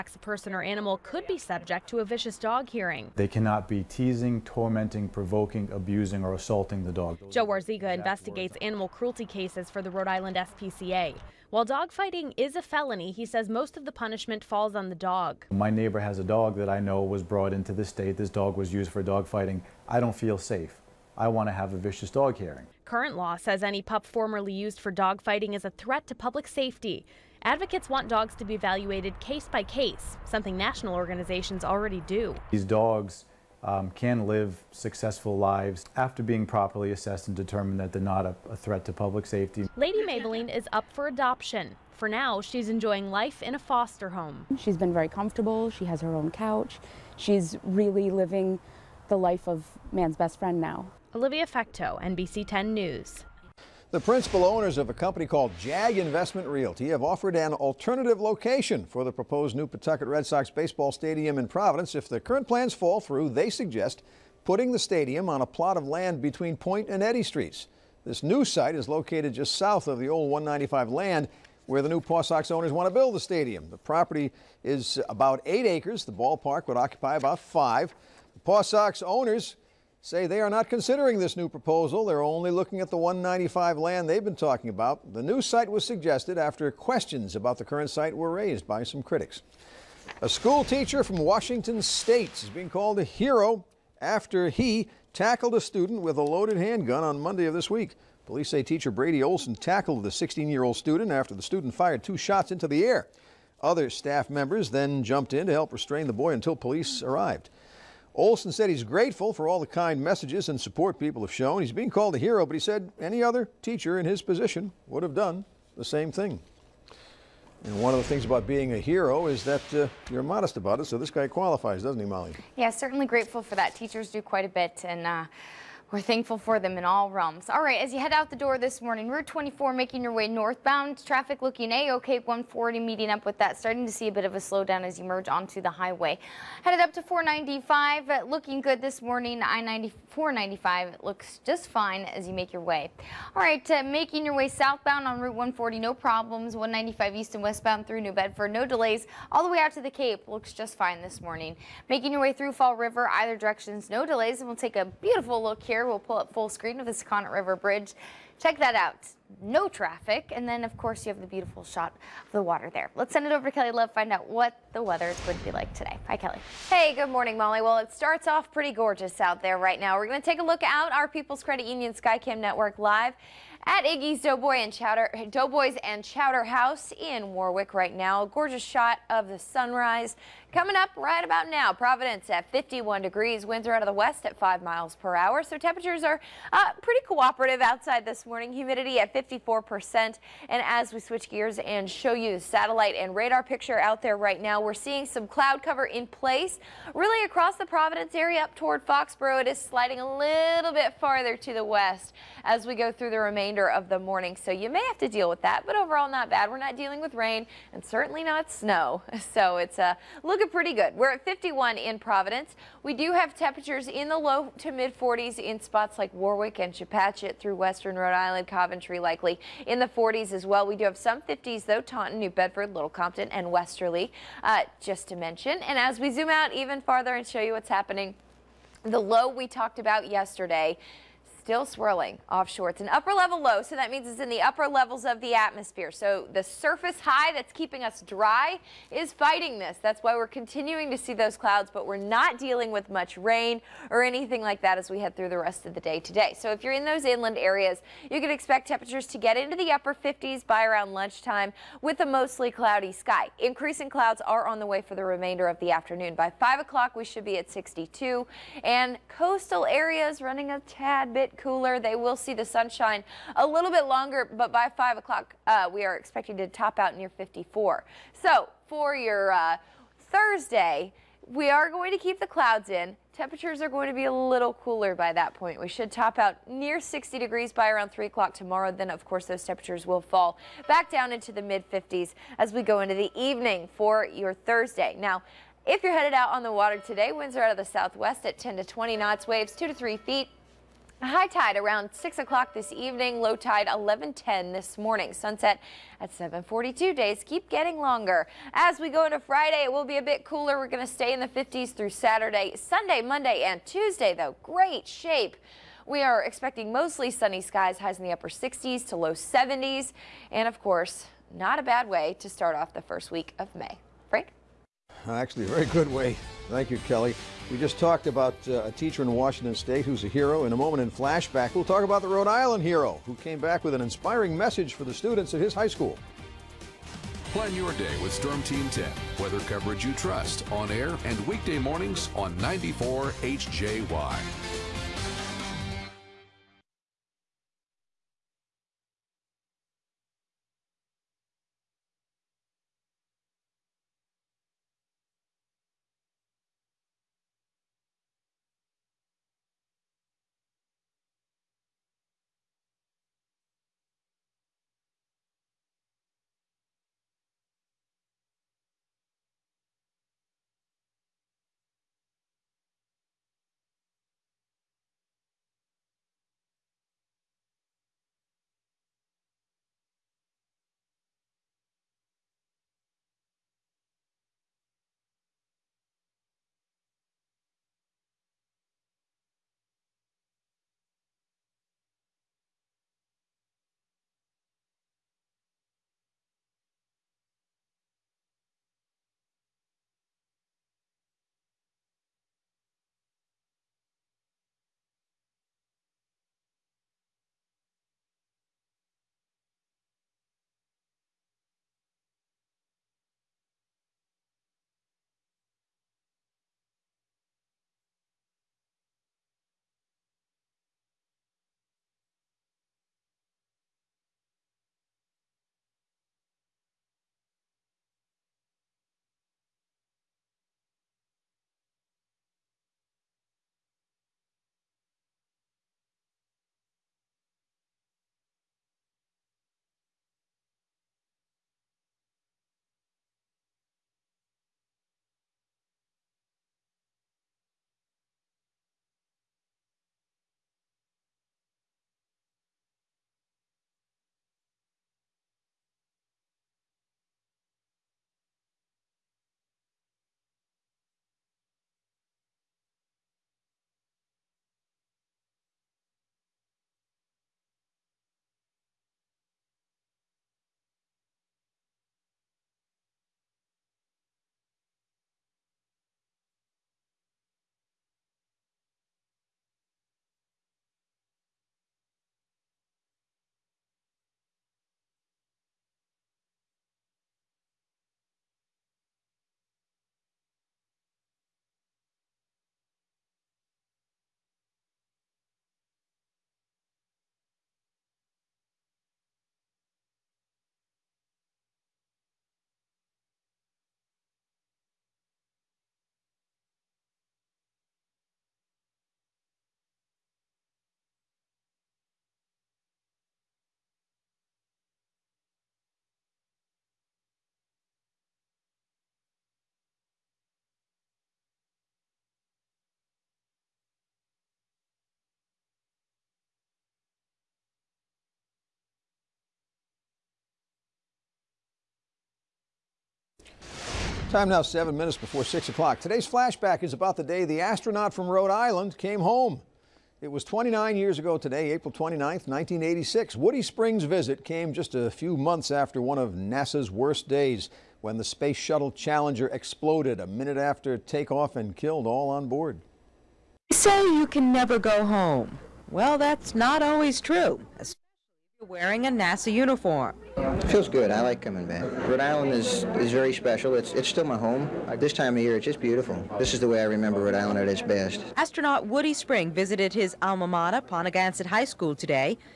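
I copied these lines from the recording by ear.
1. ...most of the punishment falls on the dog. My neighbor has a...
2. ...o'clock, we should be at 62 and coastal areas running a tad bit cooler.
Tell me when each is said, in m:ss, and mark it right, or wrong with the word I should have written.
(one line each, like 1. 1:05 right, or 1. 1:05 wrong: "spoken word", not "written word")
1. 0:13 right
2. 4:16 right.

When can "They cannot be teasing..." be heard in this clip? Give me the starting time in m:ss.
0:03.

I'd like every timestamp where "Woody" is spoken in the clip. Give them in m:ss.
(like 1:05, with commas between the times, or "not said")
8:53, 9:18.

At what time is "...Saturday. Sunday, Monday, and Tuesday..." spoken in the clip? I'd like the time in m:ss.
5:01.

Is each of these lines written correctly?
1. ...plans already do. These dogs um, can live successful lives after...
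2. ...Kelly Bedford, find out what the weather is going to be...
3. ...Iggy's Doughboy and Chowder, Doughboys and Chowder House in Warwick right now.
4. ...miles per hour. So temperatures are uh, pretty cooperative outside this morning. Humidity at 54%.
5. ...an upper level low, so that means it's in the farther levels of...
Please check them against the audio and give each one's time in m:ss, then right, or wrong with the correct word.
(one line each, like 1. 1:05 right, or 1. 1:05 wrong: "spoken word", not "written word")
1. 0:30 wrong: "organizations", not "plans"
2. 2:43 wrong: "Love", not "Bedford"
3. 2:53 right
4. 3:04 right
5. 3:52 wrong: "upper", not "farther".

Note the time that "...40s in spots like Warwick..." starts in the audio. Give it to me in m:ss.
3:34.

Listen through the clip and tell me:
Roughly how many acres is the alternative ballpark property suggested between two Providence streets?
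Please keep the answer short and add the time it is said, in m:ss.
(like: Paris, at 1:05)
8 acres, at 1:15.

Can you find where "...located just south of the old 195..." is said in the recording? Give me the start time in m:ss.
1:08.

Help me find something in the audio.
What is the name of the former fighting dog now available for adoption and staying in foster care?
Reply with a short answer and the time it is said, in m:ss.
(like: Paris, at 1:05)
Lady Maybelline, at 0:39.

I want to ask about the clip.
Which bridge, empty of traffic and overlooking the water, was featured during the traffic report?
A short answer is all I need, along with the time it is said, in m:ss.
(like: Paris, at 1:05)
Sakonnet River Bridge, at 2:36.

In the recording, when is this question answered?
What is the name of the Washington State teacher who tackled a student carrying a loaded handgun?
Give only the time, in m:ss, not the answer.
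1:38.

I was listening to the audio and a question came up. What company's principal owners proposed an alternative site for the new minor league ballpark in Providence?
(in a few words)
JAG Investment Realty.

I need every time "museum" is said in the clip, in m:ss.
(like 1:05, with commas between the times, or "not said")
not said.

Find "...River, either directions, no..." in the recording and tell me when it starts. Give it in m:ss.
2:32.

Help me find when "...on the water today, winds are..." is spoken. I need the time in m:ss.
4:46.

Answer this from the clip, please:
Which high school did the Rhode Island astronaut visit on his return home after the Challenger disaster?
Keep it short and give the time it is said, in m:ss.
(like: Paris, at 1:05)
Ponaganset High School, at 9:20.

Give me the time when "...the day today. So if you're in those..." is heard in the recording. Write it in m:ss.
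4:05.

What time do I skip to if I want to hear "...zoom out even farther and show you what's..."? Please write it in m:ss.
3:46.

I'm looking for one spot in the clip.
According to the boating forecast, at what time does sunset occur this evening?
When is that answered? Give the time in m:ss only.
4:56.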